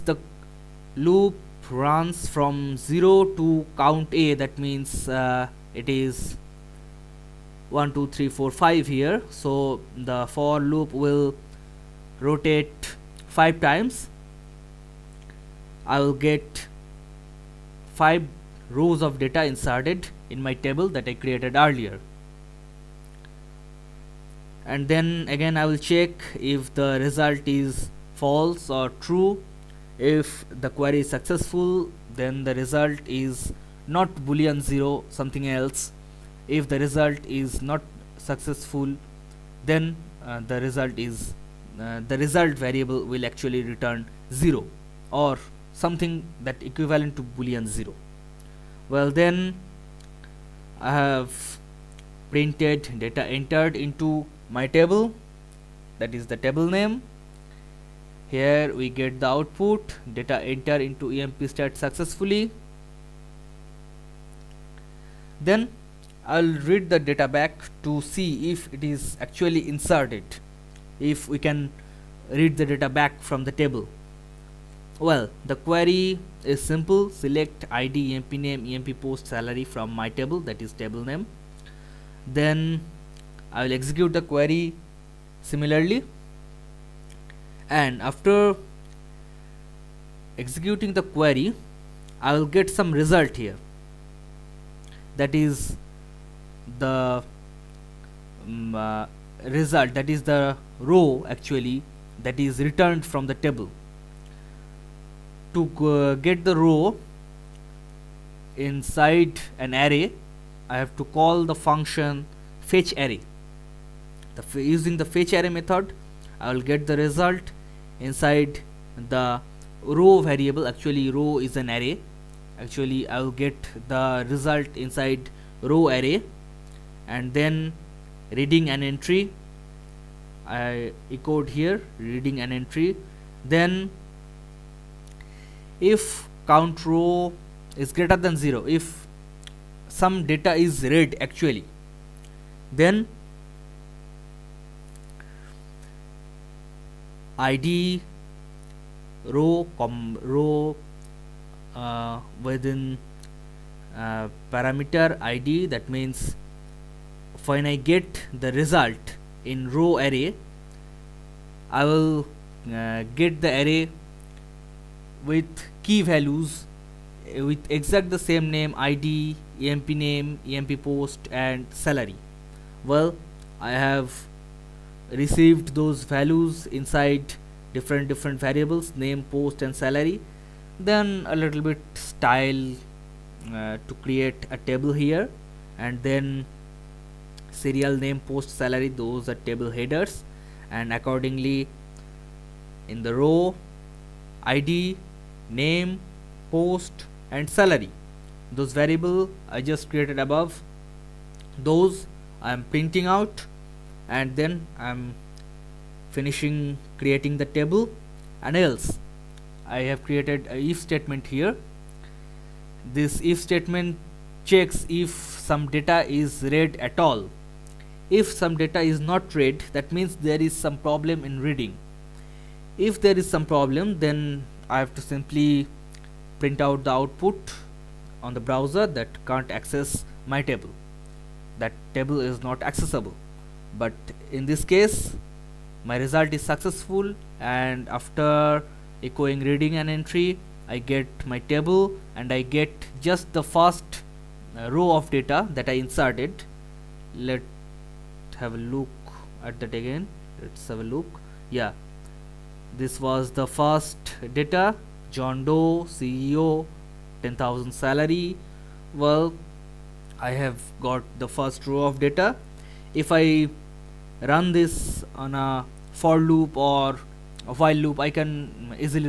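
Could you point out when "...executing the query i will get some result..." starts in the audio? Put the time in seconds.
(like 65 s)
90 s.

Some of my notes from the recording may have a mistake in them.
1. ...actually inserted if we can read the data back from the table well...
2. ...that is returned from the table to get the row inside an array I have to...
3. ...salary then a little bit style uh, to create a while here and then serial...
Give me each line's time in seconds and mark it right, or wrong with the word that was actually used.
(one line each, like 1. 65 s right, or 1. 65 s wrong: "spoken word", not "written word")
1. 69 s right
2. 102 s right
3. 179 s wrong: "table", not "while".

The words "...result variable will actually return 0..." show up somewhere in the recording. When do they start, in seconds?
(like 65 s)
42 s.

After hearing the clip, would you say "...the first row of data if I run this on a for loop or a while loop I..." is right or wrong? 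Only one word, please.
right.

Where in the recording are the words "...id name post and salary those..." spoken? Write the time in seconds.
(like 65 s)
194 s.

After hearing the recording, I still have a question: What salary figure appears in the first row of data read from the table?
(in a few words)
10,000.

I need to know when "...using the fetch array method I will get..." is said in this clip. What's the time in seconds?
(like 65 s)
114 s.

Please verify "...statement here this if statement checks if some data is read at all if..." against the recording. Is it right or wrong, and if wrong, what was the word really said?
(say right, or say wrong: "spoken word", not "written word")
right.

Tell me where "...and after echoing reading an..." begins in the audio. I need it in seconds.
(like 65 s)
237 s.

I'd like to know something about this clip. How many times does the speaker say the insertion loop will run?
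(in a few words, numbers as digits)
5.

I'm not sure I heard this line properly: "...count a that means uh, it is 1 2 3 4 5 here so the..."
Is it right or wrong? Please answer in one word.
right.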